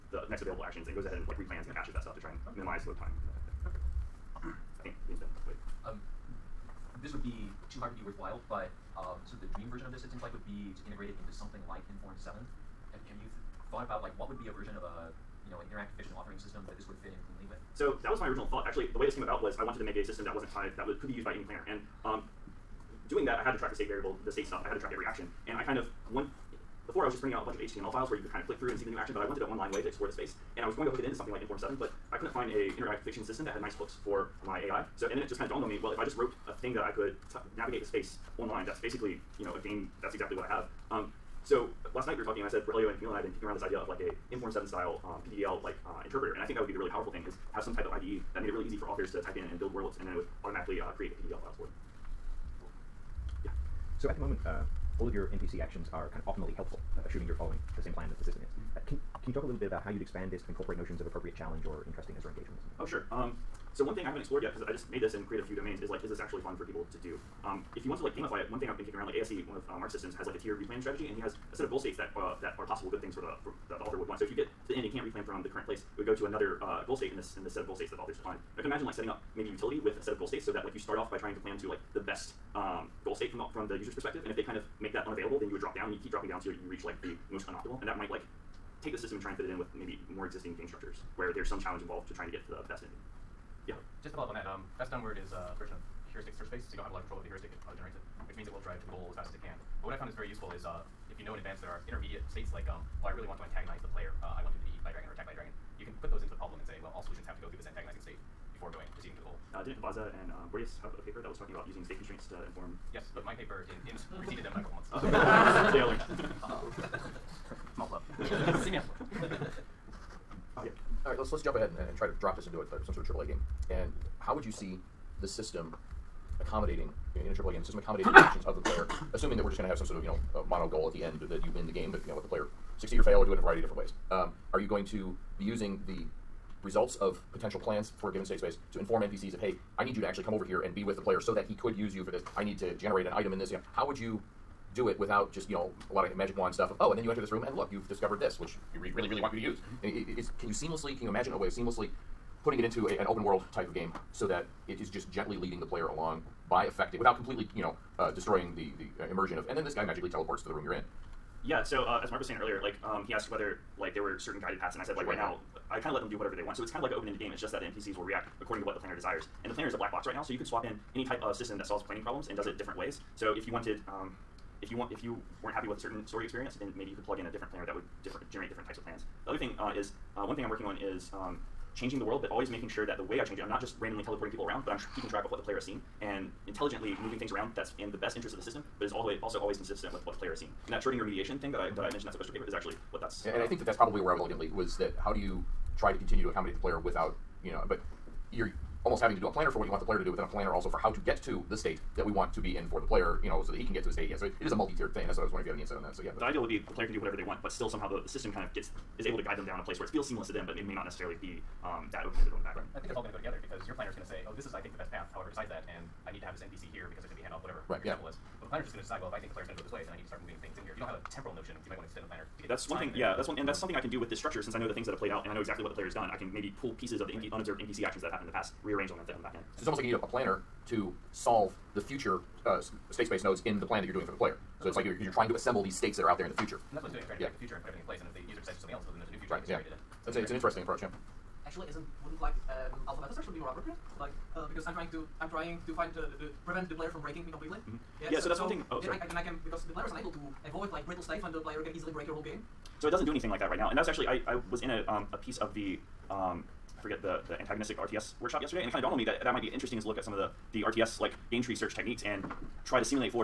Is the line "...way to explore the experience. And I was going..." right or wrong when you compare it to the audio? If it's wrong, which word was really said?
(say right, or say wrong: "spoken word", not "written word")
wrong: "space", not "experience".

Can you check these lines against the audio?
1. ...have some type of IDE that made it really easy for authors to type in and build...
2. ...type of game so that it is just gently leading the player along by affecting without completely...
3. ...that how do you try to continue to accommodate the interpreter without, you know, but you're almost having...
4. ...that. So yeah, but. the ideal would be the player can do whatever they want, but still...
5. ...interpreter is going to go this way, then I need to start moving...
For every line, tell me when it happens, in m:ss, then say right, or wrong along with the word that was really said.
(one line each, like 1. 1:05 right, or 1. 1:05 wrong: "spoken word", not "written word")
1. 0:47 right
2. 2:33 right
3. 3:14 wrong: "player", not "interpreter"
4. 3:25 right
5. 3:39 wrong: "player", not "interpreter".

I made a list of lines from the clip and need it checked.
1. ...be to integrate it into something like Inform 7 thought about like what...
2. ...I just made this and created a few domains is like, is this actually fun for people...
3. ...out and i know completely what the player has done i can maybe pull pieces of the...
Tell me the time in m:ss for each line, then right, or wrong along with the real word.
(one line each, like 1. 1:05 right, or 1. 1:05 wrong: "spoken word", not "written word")
1. 0:10 right
2. 1:04 right
3. 3:45 wrong: "exactly", not "completely".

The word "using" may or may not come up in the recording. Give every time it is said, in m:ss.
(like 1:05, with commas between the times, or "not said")
1:51, 2:15.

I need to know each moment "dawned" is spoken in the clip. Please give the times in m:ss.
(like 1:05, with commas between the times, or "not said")
0:35, 4:18.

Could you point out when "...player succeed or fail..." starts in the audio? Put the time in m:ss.
2:12.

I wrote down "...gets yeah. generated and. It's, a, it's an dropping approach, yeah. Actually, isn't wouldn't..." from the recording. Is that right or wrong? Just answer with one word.
wrong.